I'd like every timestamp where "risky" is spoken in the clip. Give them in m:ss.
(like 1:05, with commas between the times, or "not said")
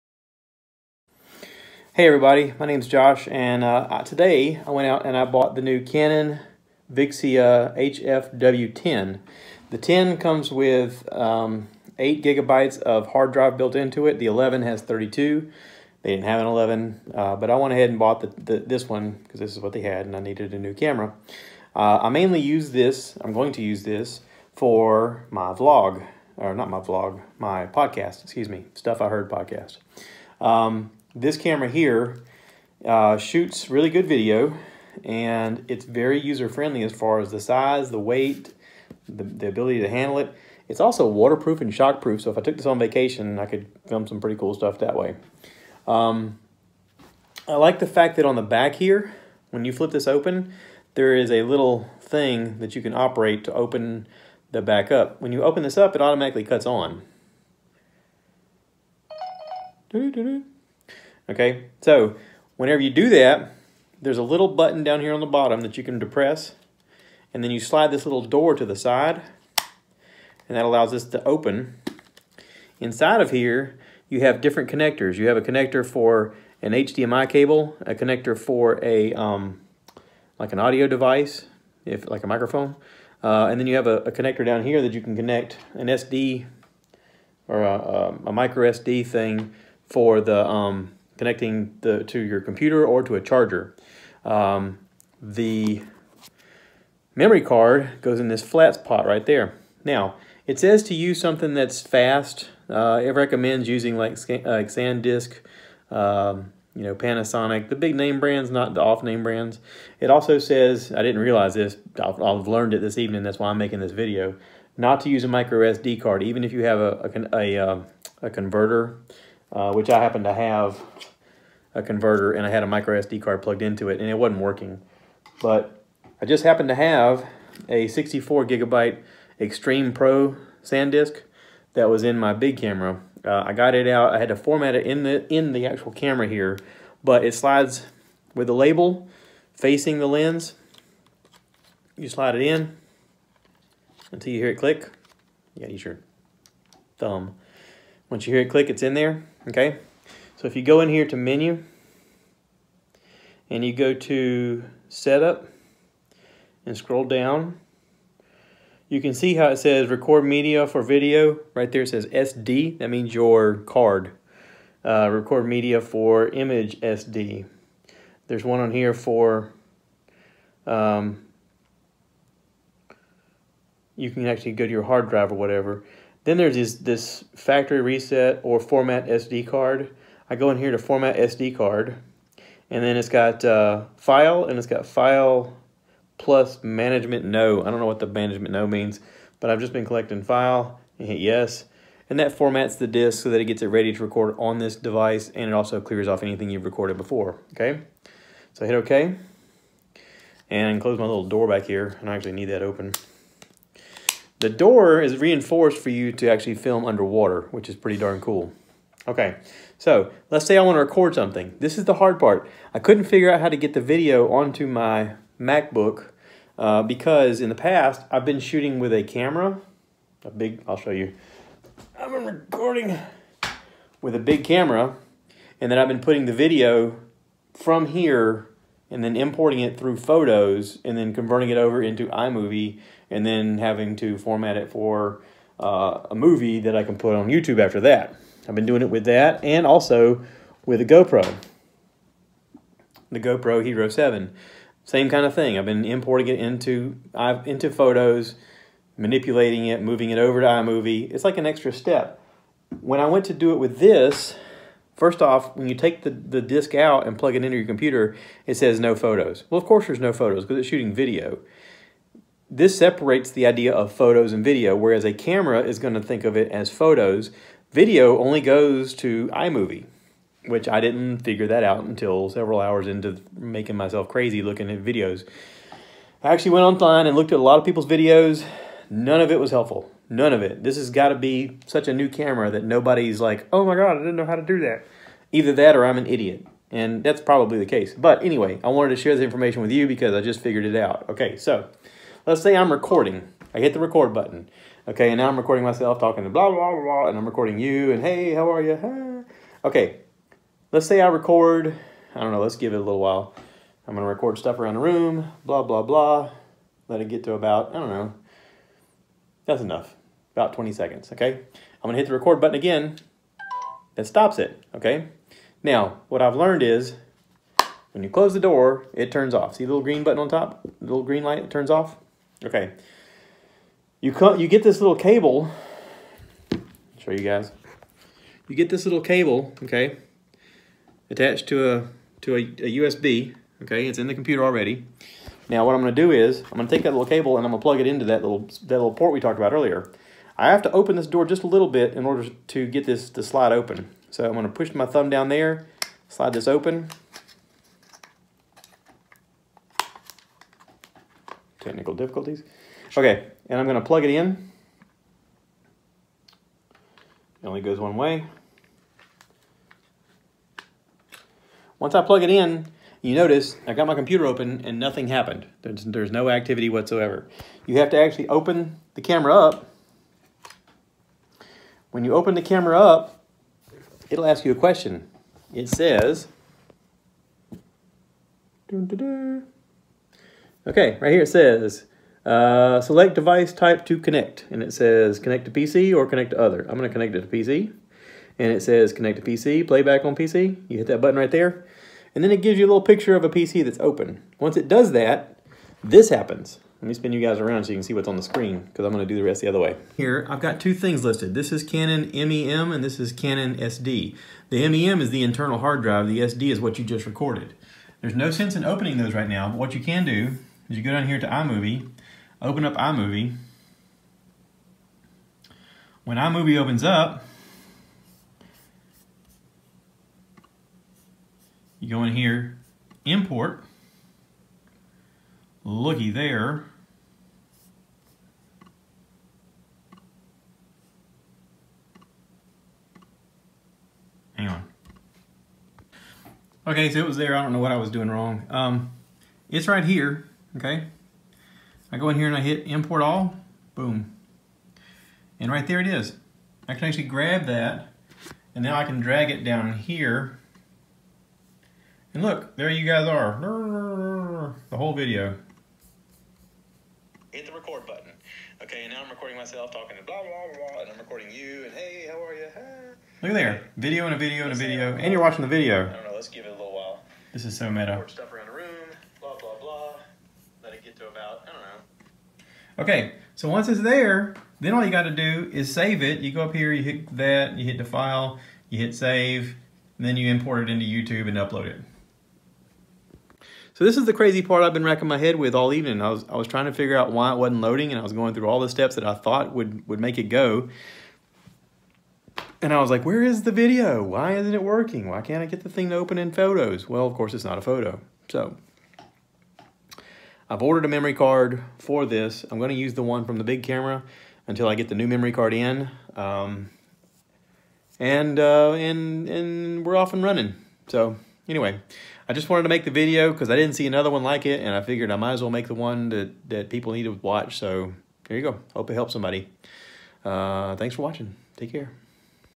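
not said.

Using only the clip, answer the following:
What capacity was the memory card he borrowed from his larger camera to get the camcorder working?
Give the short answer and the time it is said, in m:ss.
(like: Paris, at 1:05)
64 gigabytes, at 2:07.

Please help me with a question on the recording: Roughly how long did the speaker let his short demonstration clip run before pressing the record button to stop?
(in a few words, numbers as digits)
20 seconds.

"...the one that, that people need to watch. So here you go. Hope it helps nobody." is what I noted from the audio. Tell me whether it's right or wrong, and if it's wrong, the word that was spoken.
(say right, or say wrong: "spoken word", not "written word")
wrong: "somebody", not "nobody".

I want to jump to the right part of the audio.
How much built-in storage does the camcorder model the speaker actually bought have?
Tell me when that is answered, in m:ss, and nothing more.
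0:11.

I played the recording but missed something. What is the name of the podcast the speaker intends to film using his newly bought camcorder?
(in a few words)
Stuff I Heard.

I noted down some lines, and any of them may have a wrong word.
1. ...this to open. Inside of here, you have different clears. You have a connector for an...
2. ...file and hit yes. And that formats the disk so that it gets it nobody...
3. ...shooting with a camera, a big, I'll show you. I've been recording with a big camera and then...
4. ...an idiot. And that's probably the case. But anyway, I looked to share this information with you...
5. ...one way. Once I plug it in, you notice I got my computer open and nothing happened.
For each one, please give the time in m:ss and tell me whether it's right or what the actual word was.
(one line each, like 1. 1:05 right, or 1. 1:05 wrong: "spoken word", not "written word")
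1. 1:10 wrong: "connectors", not "clears"
2. 3:10 wrong: "ready", not "nobody"
3. 3:38 right
4. 4:45 wrong: "wanted", not "looked"
5. 5:57 right.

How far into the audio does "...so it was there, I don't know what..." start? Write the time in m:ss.
7:16.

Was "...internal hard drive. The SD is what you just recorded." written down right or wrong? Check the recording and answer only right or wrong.
right.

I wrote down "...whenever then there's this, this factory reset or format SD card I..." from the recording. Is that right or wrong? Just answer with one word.
wrong.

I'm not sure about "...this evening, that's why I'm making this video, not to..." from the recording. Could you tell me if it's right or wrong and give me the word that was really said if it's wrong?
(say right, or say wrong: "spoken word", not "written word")
right.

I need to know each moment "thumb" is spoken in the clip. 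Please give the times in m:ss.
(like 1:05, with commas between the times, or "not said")
2:26, 5:44.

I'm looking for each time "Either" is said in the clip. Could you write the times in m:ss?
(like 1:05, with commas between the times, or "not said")
4:45.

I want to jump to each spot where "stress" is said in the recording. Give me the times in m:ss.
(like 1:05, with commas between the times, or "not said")
not said.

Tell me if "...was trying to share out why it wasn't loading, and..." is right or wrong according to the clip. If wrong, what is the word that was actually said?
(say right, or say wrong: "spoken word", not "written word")
wrong: "figure", not "share".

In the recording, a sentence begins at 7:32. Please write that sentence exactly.
And look, there you guys are, the whole video.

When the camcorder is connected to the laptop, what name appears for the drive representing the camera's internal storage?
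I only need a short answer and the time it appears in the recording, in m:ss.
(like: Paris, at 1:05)
Canon MEM, at 6:41.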